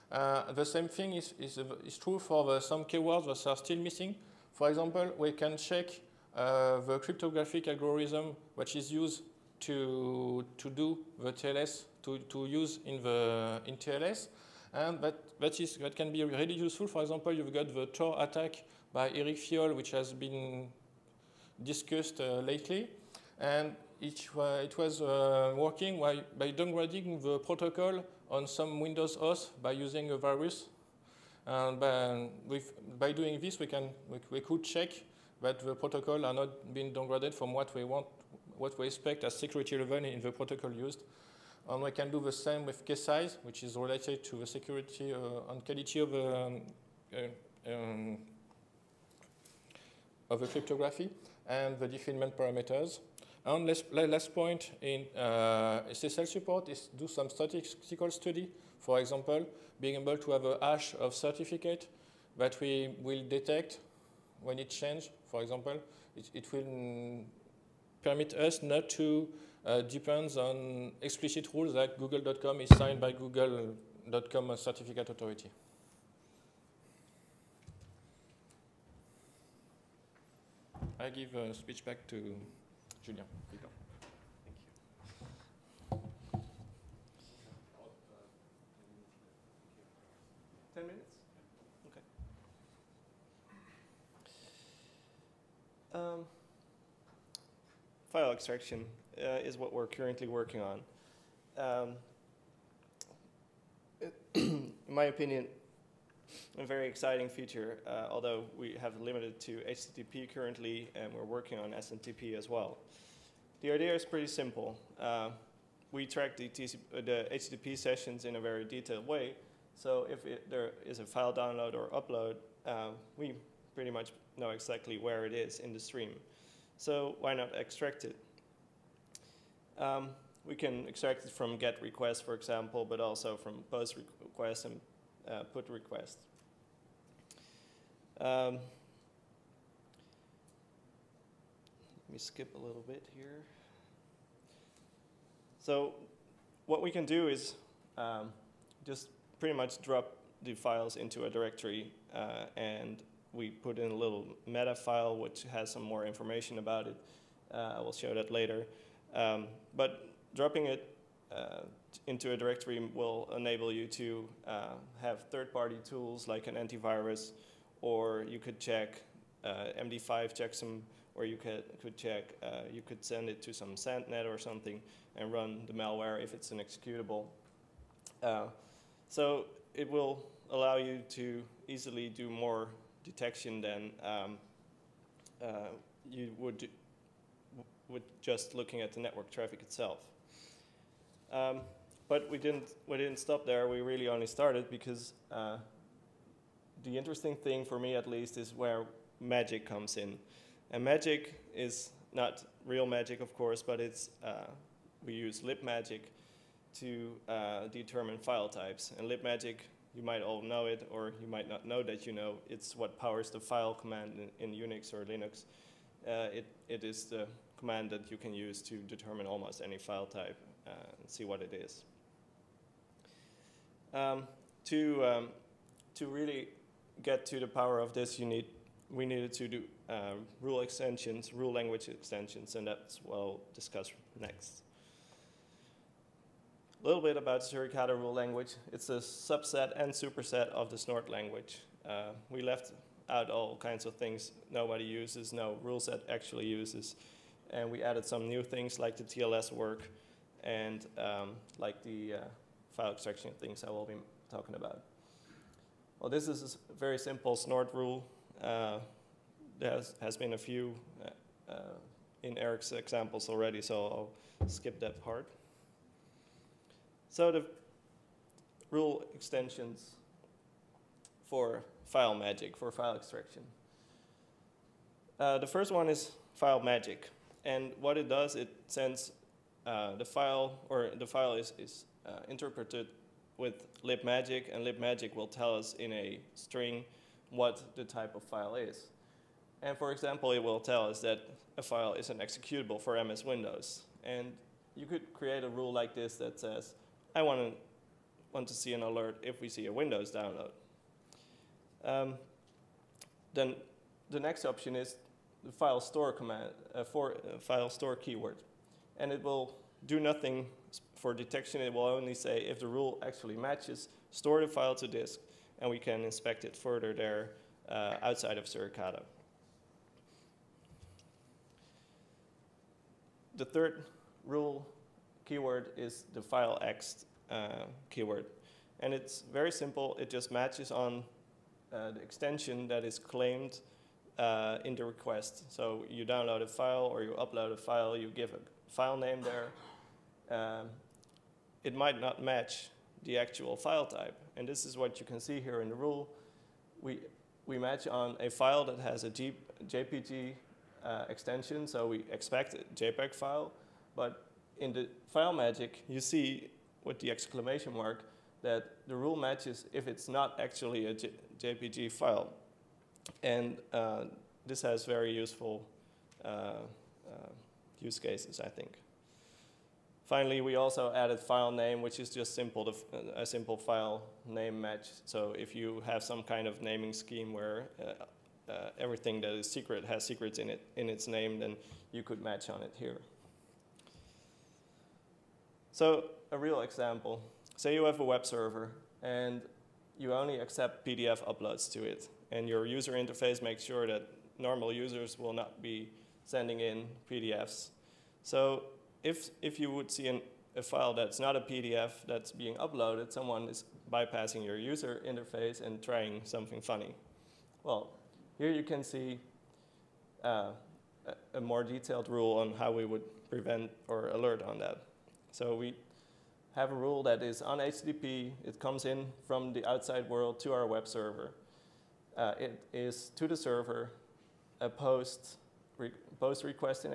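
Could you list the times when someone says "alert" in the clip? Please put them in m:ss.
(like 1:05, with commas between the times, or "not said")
4:58, 6:54.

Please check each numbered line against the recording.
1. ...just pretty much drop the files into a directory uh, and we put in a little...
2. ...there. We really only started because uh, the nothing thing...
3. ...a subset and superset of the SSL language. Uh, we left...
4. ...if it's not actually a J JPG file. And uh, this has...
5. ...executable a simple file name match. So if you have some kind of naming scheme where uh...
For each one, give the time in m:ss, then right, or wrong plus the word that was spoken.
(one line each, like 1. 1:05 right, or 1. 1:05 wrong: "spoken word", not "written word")
1. 2:28 right
2. 3:13 wrong: "interesting", not "nothing"
3. 3:58 wrong: "Snort", not "SSL"
4. 5:59 right
5. 6:12 wrong: "simple", not "executable".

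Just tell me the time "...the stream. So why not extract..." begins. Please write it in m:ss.
2:05.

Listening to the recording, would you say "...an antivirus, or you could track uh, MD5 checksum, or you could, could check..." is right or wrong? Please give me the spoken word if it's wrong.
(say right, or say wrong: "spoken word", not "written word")
wrong: "check", not "track".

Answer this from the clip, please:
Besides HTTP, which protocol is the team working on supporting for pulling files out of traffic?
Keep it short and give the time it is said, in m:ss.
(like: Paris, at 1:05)
SMTP, at 1:51.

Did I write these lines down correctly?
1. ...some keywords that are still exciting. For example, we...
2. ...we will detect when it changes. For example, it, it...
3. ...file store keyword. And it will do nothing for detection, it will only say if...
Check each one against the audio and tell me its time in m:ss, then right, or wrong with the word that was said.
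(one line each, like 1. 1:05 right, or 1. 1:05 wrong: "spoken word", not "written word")
1. 0:02 wrong: "missing", not "exciting"
2. 1:02 right
3. 5:07 right.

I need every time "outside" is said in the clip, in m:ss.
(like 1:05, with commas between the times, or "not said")
5:18, 6:59.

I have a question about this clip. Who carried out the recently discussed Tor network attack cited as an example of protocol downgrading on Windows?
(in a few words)
Eric Filiol.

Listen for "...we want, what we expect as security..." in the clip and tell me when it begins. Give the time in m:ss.
0:37.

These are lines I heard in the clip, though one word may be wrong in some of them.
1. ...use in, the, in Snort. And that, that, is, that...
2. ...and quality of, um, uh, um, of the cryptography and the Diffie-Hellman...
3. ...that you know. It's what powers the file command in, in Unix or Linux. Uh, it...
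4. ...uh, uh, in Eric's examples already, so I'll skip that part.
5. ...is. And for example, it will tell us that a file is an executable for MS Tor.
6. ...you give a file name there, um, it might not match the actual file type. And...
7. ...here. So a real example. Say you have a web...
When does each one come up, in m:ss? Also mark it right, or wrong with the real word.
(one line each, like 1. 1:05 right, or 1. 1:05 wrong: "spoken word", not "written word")
1. 0:12 wrong: "TLS", not "Snort"
2. 0:45 right
3. 3:31 right
4. 4:21 right
5. 4:48 wrong: "Windows", not "Tor"
6. 5:37 right
7. 6:22 right.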